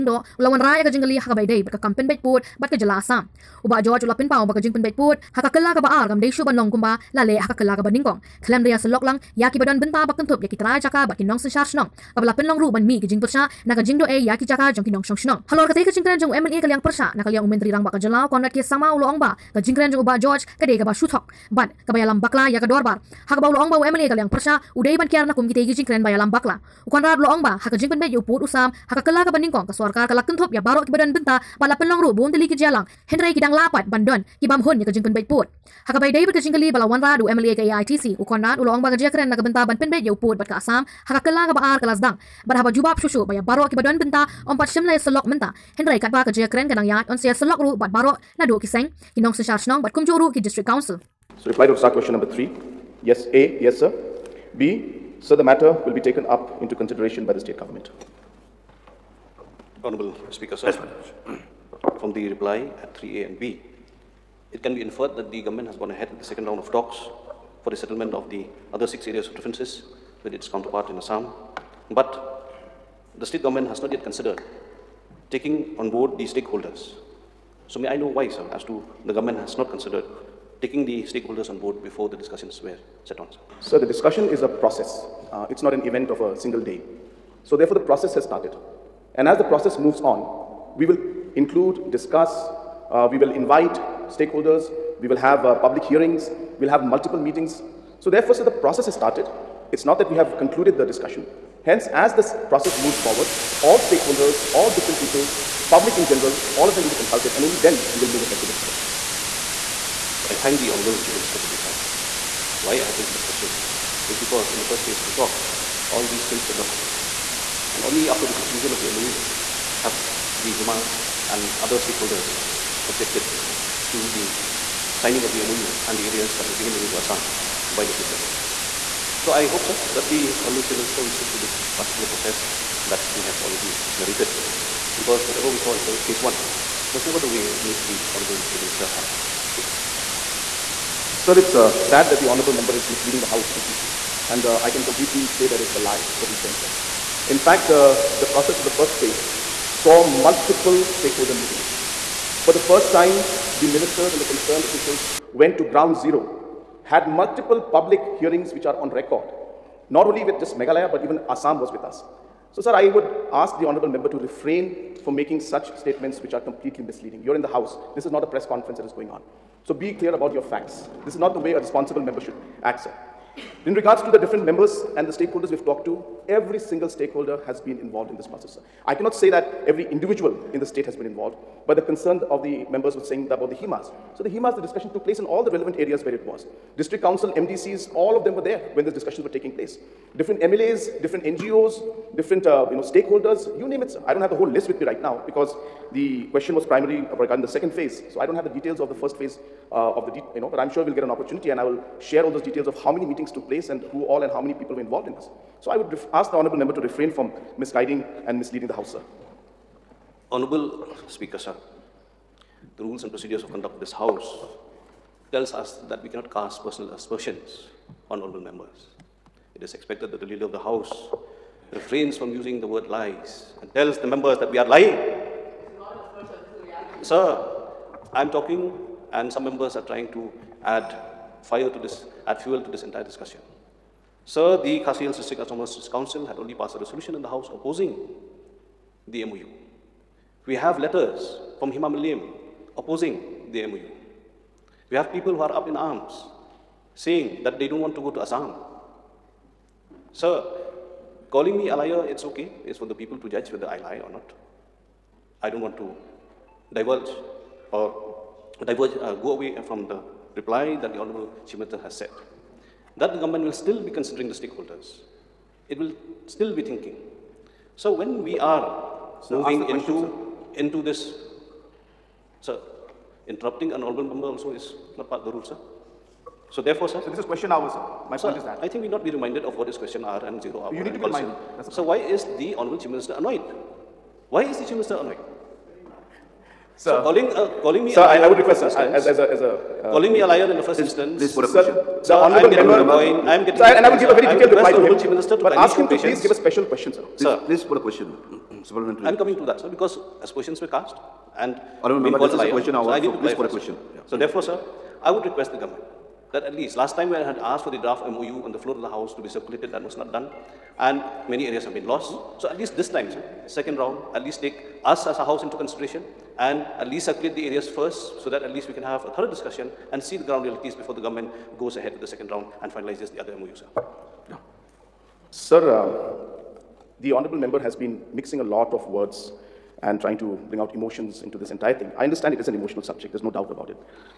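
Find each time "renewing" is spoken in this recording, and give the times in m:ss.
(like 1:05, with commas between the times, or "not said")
not said.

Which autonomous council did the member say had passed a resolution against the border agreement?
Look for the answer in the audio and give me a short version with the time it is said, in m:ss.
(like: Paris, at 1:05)
Khasi Hills District Autonomous Council, at 3:54.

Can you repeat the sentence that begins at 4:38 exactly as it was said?
I think we not be reminded of what is question R and zero R.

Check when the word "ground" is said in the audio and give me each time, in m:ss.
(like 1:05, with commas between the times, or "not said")
2:35, 5:20.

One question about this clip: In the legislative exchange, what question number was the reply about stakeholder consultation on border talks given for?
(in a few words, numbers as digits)
3.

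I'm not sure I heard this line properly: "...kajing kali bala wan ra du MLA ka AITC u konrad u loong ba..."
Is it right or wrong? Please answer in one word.
right.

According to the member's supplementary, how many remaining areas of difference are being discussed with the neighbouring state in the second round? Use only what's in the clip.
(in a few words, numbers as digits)
6.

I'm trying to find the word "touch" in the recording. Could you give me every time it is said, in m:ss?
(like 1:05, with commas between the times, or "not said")
not said.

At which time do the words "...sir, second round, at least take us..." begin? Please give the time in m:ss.
5:13.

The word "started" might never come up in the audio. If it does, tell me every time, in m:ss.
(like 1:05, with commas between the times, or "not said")
1:28, 1:38.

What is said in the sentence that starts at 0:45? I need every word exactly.
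Hendrai katba kerja keren kenang yat on saya selok ru bat baru nadu kiseng seng.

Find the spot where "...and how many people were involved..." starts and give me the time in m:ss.
3:24.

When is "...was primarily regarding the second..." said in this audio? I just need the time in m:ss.
3:16.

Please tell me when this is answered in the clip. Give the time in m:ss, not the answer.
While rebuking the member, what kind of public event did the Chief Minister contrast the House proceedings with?
2:48.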